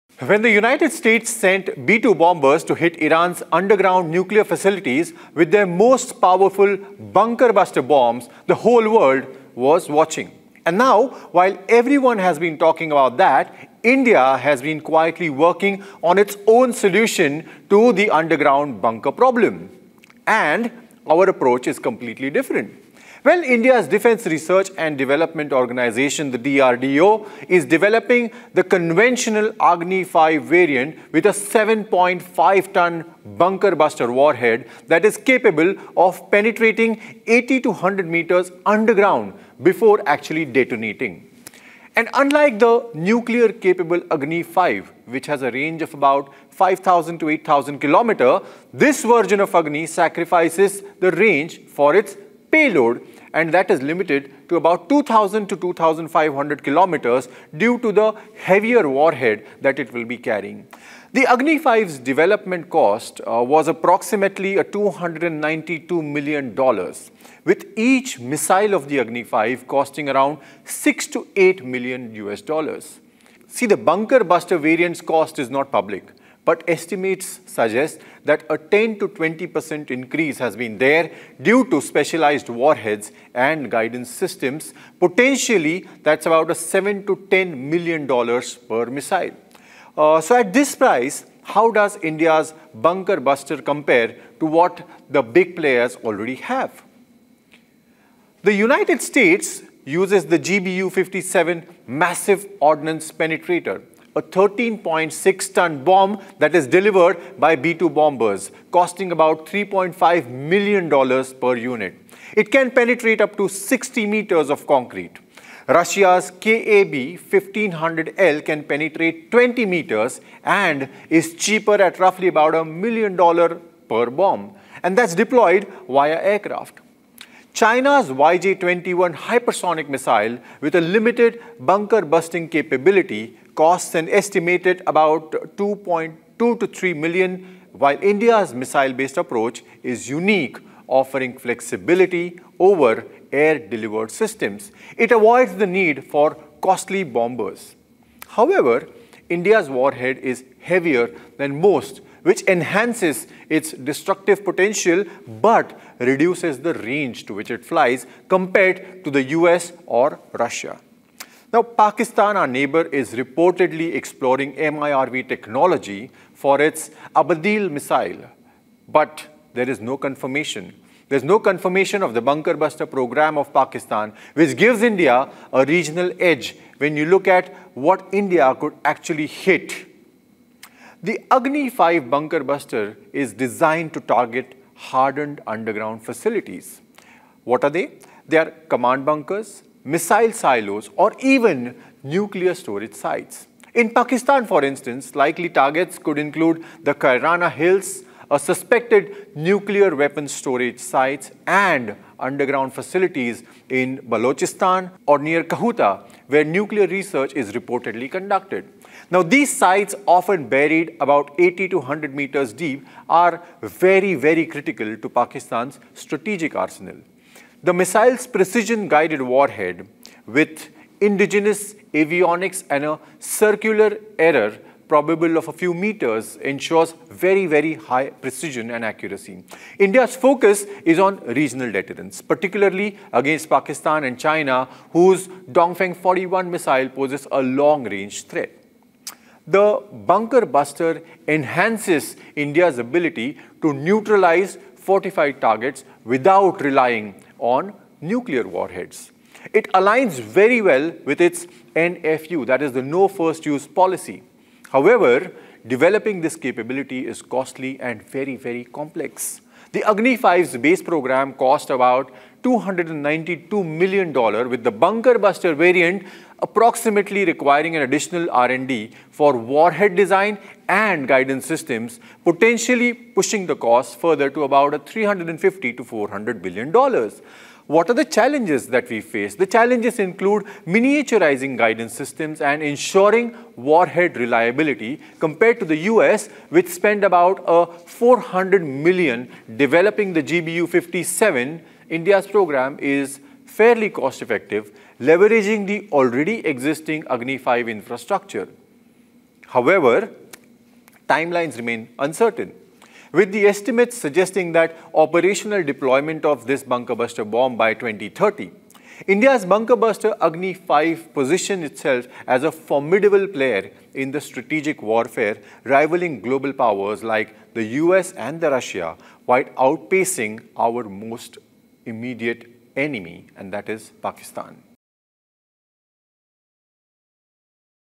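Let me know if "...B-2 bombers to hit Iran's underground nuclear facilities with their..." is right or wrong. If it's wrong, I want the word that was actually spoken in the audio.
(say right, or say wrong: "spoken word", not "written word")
right.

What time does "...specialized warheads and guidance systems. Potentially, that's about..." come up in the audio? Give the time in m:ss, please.
1:21.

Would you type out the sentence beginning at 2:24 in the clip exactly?
It avoids the need for costly bombers.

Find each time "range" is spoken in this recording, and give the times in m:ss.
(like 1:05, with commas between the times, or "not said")
0:45, 0:51, 2:36, 3:57.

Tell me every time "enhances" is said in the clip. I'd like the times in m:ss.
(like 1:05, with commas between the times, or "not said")
2:32, 4:01.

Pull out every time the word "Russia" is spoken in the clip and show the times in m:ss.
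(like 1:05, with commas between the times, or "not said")
1:55, 2:40, 5:18.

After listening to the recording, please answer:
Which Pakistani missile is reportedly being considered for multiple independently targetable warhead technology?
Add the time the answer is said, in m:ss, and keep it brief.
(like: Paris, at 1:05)
Ababeel, at 2:47.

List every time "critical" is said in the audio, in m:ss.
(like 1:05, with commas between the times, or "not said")
3:34.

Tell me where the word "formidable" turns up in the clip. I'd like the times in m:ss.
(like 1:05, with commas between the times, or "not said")
5:12.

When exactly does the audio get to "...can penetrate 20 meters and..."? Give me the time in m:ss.
1:58.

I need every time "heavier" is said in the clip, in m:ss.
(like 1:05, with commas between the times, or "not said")
0:58, 2:30.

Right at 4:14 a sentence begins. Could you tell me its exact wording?
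However, developing this capability is costly and very, very complex.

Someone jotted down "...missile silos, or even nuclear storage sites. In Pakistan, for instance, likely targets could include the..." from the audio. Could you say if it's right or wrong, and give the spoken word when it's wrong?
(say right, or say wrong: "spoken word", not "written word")
right.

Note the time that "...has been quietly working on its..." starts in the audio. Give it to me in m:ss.
0:14.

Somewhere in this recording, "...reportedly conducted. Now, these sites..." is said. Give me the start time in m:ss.
3:27.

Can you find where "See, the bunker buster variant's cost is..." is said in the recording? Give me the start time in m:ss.
1:13.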